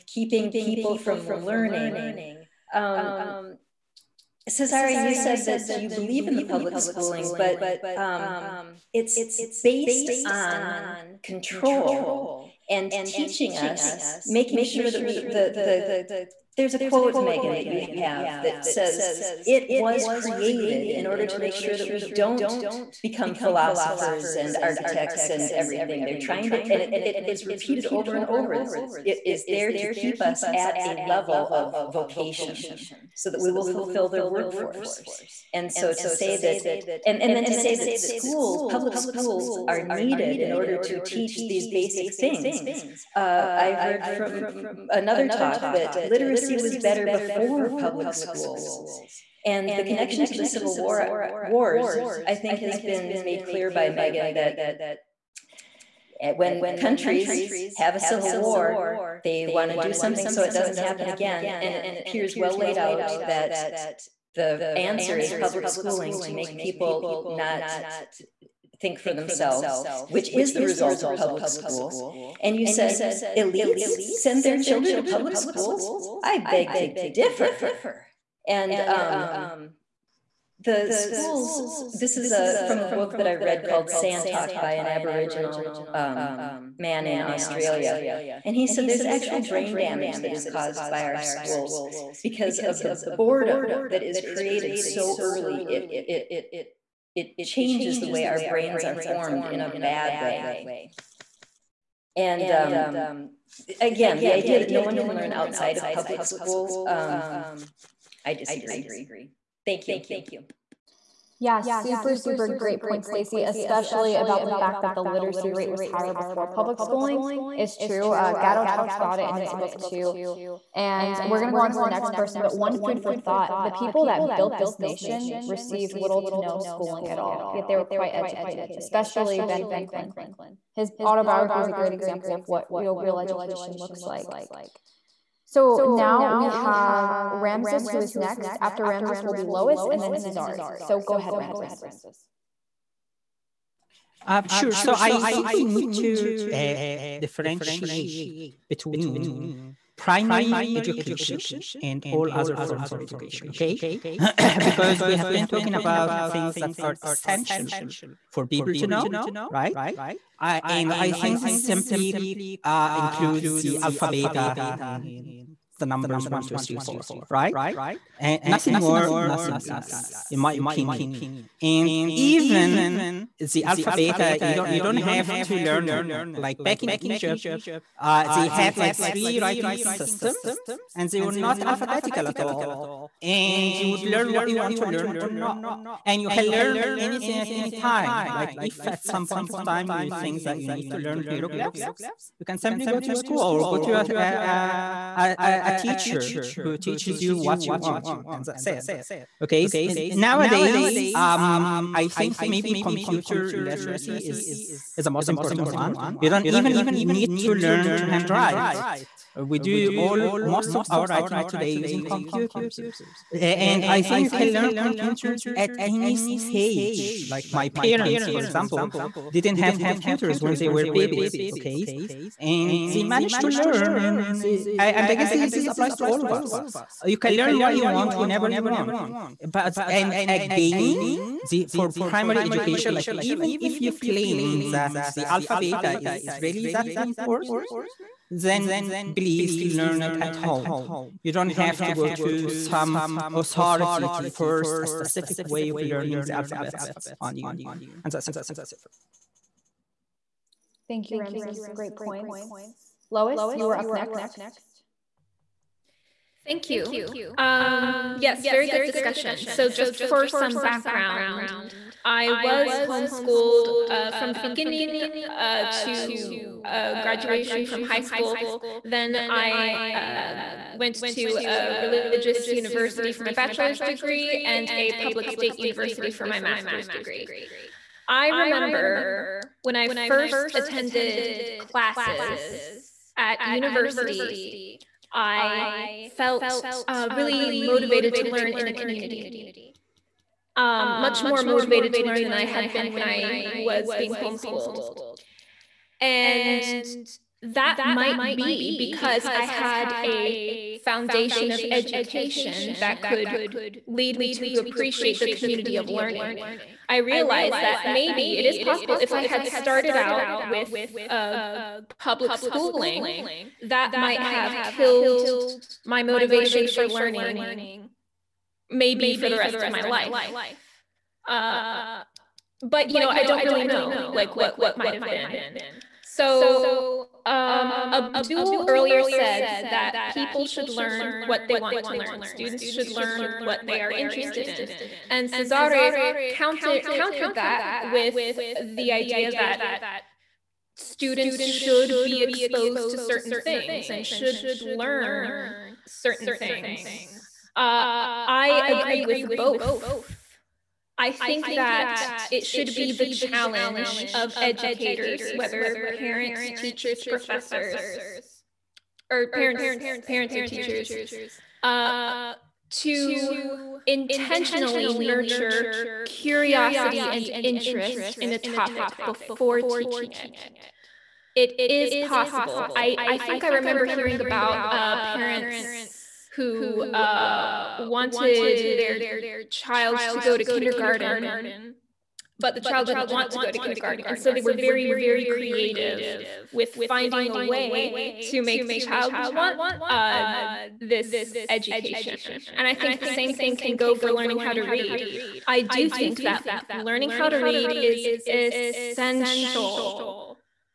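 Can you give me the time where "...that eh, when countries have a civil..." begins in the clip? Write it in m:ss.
0:54.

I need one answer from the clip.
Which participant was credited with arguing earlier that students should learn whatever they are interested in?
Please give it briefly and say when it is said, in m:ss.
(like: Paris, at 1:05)
Abdul, at 5:27.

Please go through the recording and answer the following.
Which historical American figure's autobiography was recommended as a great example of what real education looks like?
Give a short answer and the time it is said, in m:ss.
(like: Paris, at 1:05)
Ben Franklin, at 2:09.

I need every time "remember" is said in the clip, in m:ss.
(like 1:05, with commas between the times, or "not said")
4:38, 6:13.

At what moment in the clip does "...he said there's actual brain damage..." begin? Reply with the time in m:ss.
1:28.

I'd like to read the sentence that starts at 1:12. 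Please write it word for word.
And you said, elites send their children to public schools?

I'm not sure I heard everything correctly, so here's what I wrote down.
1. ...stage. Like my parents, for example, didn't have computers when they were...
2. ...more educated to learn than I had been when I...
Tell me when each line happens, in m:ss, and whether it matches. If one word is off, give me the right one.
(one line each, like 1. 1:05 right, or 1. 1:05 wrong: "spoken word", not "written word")
1. 3:36 right
2. 4:51 wrong: "motivated", not "educated".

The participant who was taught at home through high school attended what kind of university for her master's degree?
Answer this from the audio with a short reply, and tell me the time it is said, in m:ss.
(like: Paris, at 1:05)
Public state university, at 4:34.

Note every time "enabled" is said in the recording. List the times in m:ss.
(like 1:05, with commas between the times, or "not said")
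not said.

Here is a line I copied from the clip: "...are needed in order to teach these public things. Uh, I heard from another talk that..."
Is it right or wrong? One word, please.
wrong.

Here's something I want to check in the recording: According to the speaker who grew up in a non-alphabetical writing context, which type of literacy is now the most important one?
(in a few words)
Computer literacy.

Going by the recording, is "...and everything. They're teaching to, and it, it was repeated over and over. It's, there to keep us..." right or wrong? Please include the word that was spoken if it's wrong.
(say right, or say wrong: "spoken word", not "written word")
wrong: "trying", not "teaching".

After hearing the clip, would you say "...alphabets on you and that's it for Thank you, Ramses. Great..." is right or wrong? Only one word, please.
right.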